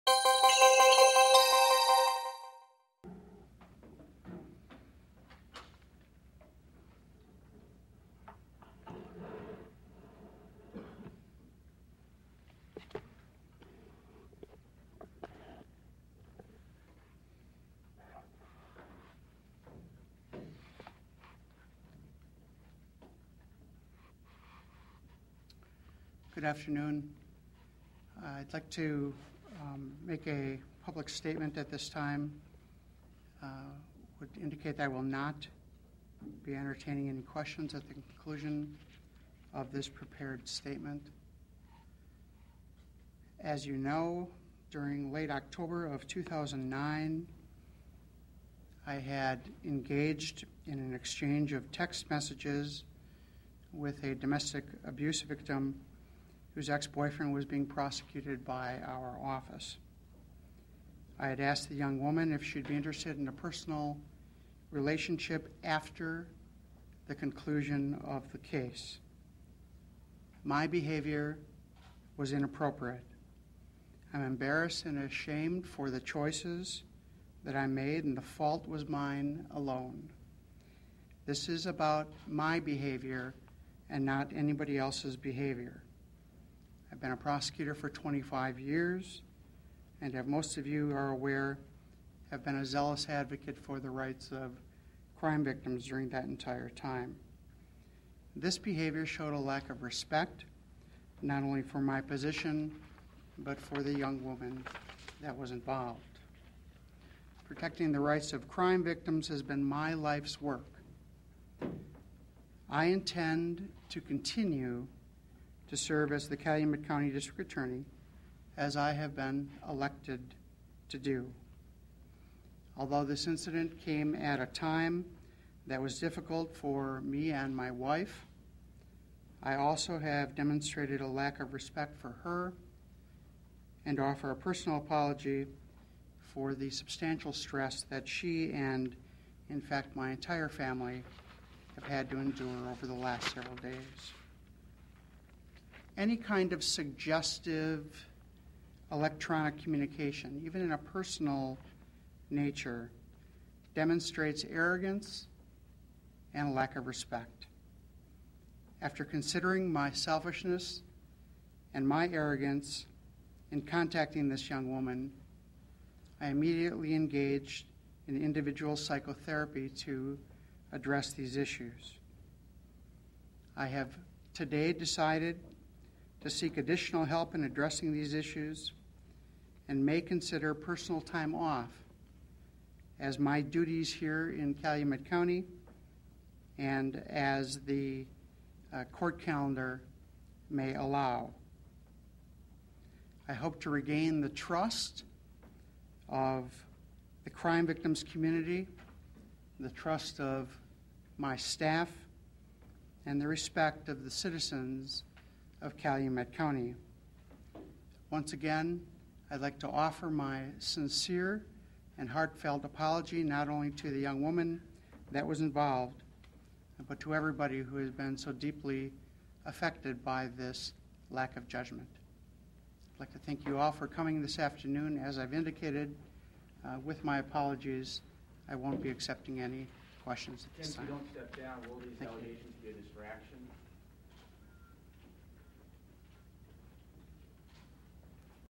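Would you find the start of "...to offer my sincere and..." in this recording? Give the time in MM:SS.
03:29.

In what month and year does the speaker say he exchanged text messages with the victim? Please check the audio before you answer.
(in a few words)
October 2009.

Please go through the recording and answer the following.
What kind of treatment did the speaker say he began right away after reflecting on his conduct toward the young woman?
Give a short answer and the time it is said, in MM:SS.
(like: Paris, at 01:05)
Individual psychotherapy, at 02:48.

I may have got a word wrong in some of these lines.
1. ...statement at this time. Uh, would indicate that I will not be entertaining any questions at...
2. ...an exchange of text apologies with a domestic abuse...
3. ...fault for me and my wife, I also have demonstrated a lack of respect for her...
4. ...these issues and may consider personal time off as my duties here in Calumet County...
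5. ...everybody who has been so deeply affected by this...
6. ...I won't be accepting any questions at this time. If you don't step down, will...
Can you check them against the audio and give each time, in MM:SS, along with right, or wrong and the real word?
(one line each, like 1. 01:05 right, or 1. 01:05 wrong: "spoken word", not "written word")
1. 00:31 right
2. 00:50 wrong: "messages", not "apologies"
3. 02:05 wrong: "difficult", not "fault"
4. 02:57 right
5. 03:37 right
6. 03:48 right.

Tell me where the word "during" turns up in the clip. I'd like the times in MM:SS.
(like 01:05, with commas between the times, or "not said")
00:44, 01:35.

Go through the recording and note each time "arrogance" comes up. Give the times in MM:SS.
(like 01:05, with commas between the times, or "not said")
02:34, 02:42.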